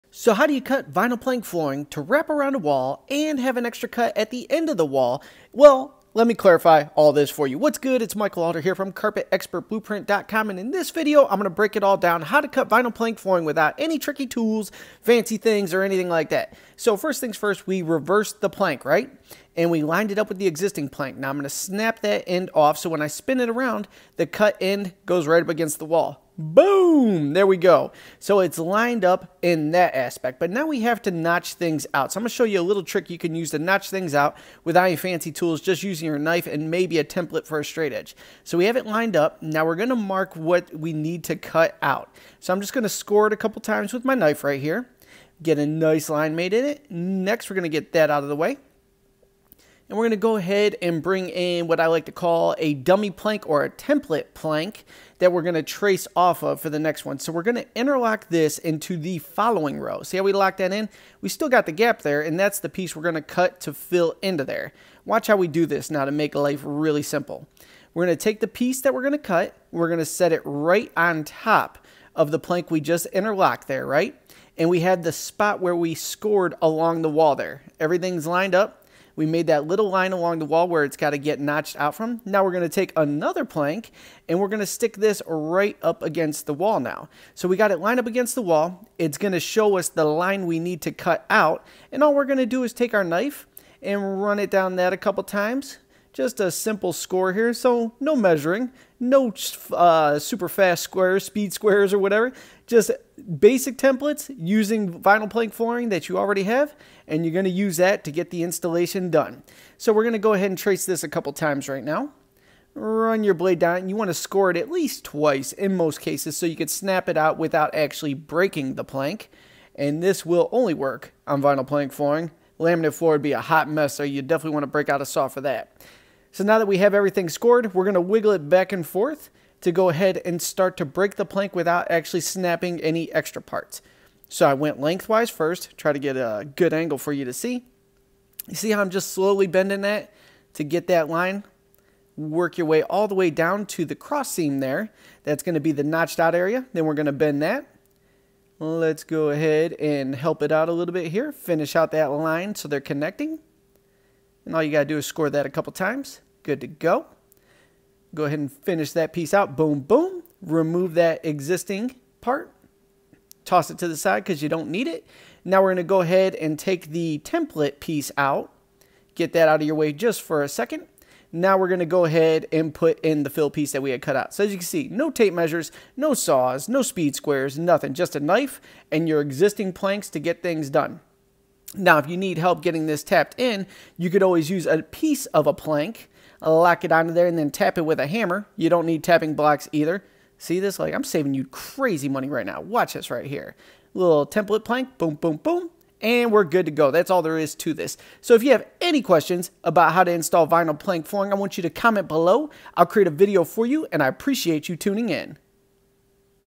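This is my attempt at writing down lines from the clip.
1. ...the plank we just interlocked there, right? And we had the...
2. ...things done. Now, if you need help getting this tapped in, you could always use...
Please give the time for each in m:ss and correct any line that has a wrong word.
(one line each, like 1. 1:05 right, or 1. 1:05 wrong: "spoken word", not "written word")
1. 1:12 right
2. 3:00 right.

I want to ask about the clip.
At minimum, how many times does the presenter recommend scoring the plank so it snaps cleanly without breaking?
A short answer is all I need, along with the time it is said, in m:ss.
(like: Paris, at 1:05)
twice, at 1:55.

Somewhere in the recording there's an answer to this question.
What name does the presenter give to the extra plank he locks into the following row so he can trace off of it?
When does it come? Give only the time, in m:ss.
0:52.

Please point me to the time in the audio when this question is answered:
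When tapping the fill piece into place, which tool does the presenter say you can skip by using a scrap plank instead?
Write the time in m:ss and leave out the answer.
3:09.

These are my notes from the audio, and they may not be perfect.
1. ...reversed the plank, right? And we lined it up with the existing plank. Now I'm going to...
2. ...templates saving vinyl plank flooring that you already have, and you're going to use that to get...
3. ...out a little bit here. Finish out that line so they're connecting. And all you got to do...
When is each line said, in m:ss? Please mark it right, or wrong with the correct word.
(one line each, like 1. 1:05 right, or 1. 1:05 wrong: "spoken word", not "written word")
1. 0:17 right
2. 1:43 wrong: "using", not "saving"
3. 2:30 right.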